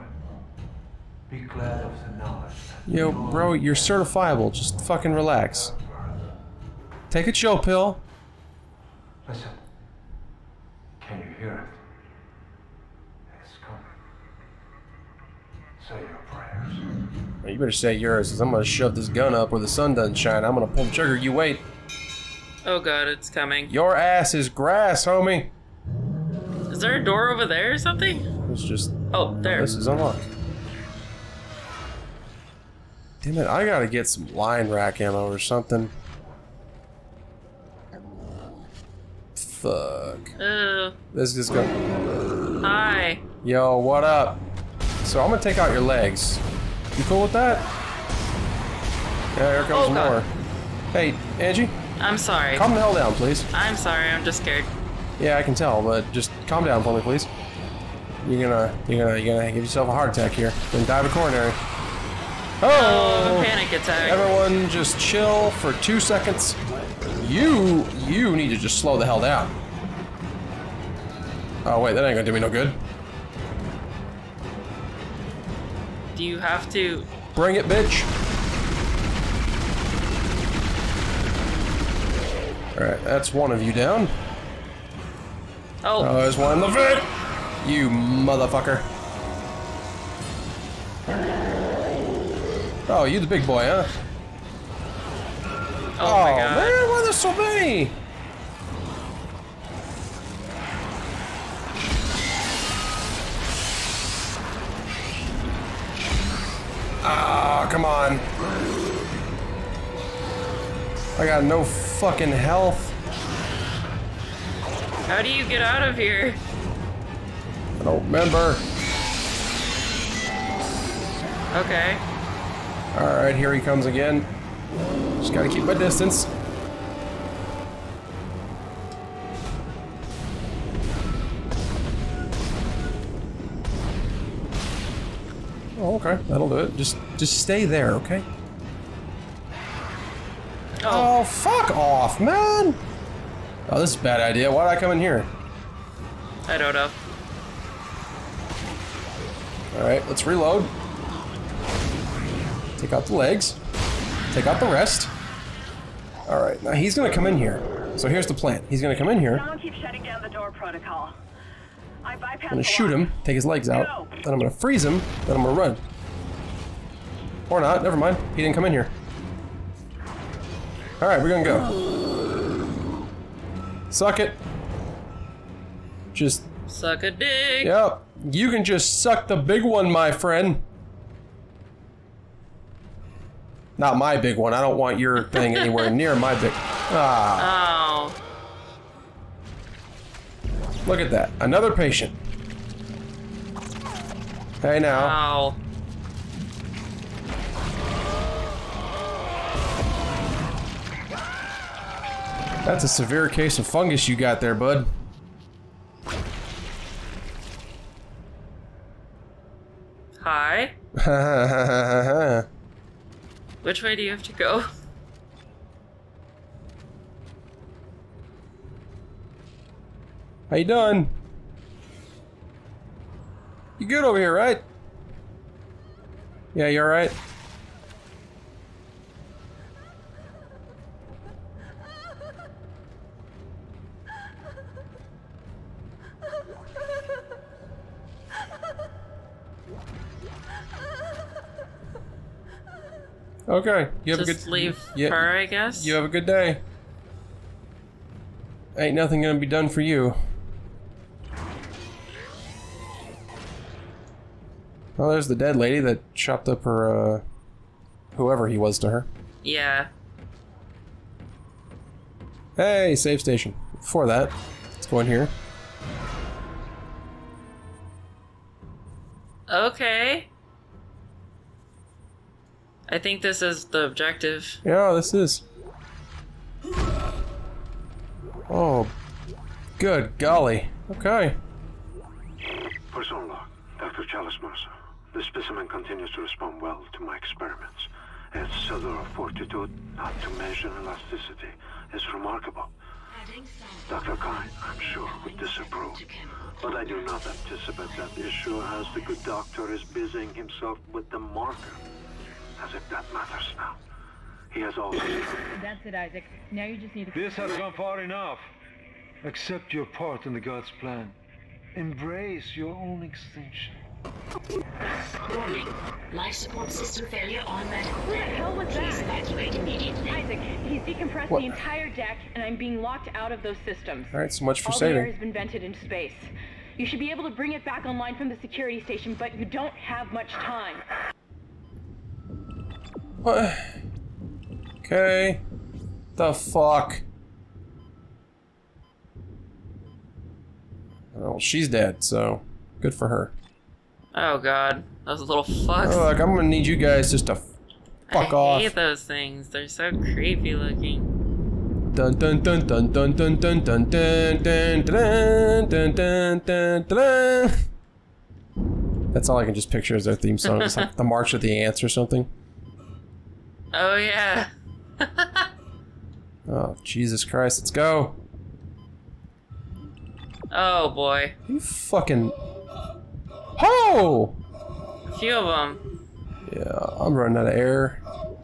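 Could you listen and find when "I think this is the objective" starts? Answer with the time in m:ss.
4:32.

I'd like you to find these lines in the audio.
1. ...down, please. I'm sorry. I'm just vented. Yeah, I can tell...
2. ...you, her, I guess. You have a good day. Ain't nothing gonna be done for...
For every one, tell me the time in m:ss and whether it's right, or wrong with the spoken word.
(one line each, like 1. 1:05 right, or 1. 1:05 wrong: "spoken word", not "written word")
1. 0:52 wrong: "scared", not "vented"
2. 4:04 right.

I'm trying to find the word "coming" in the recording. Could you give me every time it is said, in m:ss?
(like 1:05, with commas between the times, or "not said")
0:13, 0:23.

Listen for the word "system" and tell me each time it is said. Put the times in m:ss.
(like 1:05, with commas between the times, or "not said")
5:16, 5:23.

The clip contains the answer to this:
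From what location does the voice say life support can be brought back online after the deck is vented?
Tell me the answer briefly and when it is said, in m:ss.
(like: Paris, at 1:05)
security station, at 5:28.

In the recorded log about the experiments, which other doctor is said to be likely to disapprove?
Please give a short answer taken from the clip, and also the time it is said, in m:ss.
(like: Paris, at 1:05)
Dr. Kyne, at 4:53.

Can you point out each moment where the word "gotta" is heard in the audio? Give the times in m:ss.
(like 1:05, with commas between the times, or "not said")
0:33, 2:05.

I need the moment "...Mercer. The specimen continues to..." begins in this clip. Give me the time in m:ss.
4:44.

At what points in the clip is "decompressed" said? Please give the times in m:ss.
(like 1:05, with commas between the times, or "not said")
5:20.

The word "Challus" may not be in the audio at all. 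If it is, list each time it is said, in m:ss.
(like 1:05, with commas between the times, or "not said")
4:44.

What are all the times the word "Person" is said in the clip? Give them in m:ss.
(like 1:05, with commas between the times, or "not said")
4:42.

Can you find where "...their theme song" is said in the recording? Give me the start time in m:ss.
6:00.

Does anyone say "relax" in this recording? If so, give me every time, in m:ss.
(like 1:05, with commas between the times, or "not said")
0:05.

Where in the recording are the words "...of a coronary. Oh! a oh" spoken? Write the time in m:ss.
1:00.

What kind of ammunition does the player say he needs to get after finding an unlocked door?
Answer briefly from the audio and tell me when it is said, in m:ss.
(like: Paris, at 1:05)
line rack ammo, at 0:34.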